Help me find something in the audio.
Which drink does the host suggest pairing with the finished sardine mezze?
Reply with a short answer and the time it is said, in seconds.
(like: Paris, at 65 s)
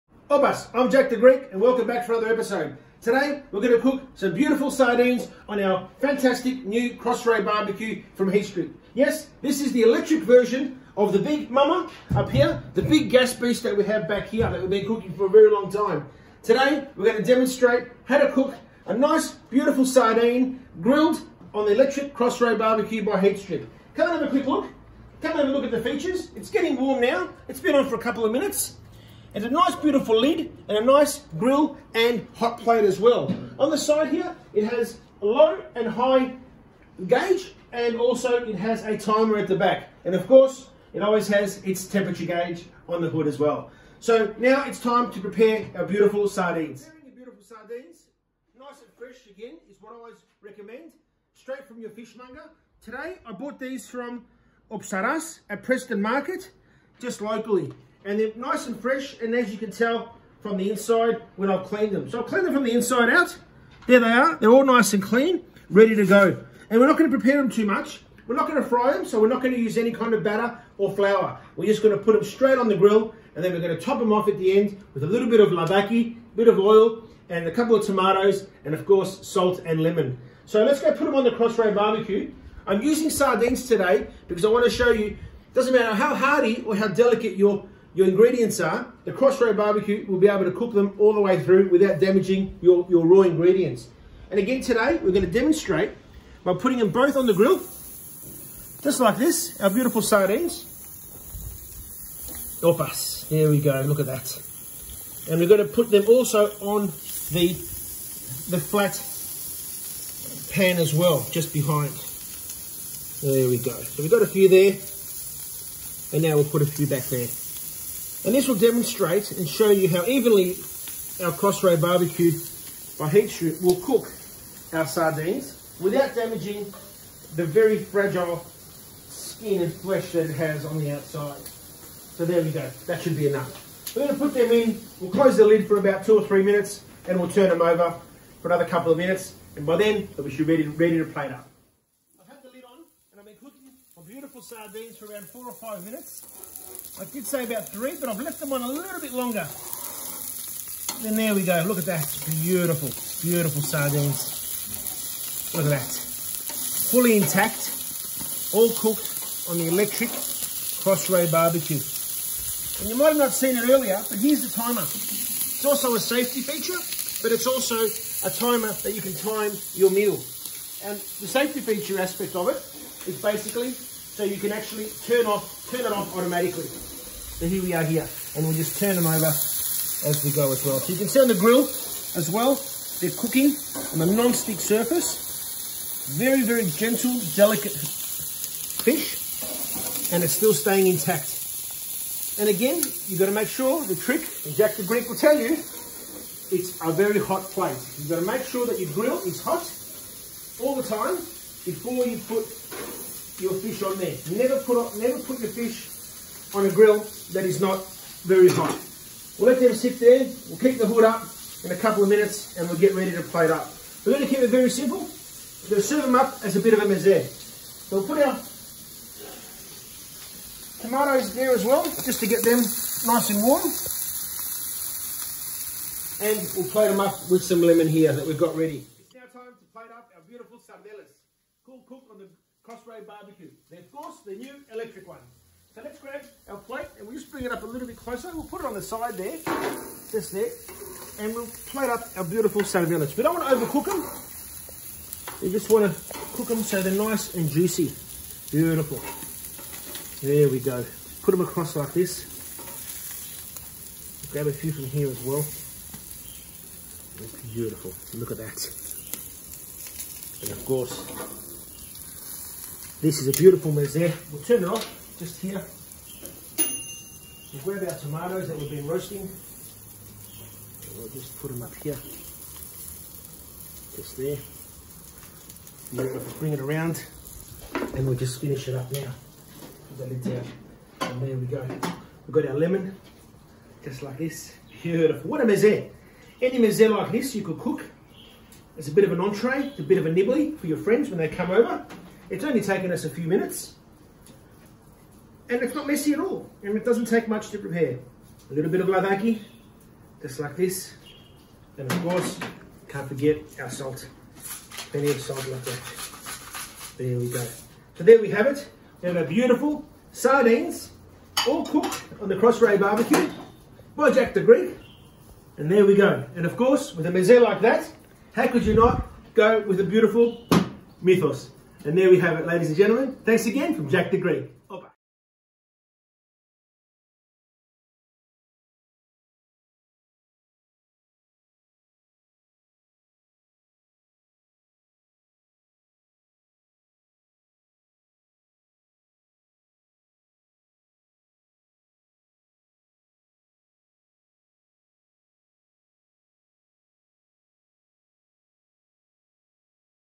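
Mythos, at 321 s.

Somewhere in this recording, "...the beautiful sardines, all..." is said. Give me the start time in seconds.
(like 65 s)
309 s.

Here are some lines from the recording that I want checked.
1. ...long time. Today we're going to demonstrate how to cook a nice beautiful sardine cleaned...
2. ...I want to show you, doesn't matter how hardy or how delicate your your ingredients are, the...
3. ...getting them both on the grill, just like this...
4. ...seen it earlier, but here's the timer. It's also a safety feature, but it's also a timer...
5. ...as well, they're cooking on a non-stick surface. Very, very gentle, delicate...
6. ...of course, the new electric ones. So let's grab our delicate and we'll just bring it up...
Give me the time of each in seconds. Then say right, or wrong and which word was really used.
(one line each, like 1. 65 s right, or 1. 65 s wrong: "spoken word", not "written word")
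1. 15 s wrong: "grilled", not "cleaned"
2. 84 s right
3. 96 s wrong: "putting", not "getting"
4. 163 s right
5. 181 s right
6. 233 s wrong: "plate", not "delicate".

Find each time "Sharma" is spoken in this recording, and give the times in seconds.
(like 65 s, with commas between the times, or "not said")
not said.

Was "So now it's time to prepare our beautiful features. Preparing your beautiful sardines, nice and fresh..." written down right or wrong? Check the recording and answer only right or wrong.
wrong.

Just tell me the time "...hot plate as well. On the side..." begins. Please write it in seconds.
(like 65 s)
32 s.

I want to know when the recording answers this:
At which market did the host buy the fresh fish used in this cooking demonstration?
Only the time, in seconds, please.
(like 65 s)
55 s.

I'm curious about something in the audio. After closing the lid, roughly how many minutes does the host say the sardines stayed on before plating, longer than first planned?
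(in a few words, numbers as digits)
4 or 5 minutes.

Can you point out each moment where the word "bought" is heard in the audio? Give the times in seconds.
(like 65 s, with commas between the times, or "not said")
53 s.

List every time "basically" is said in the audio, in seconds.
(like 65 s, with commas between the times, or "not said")
173 s.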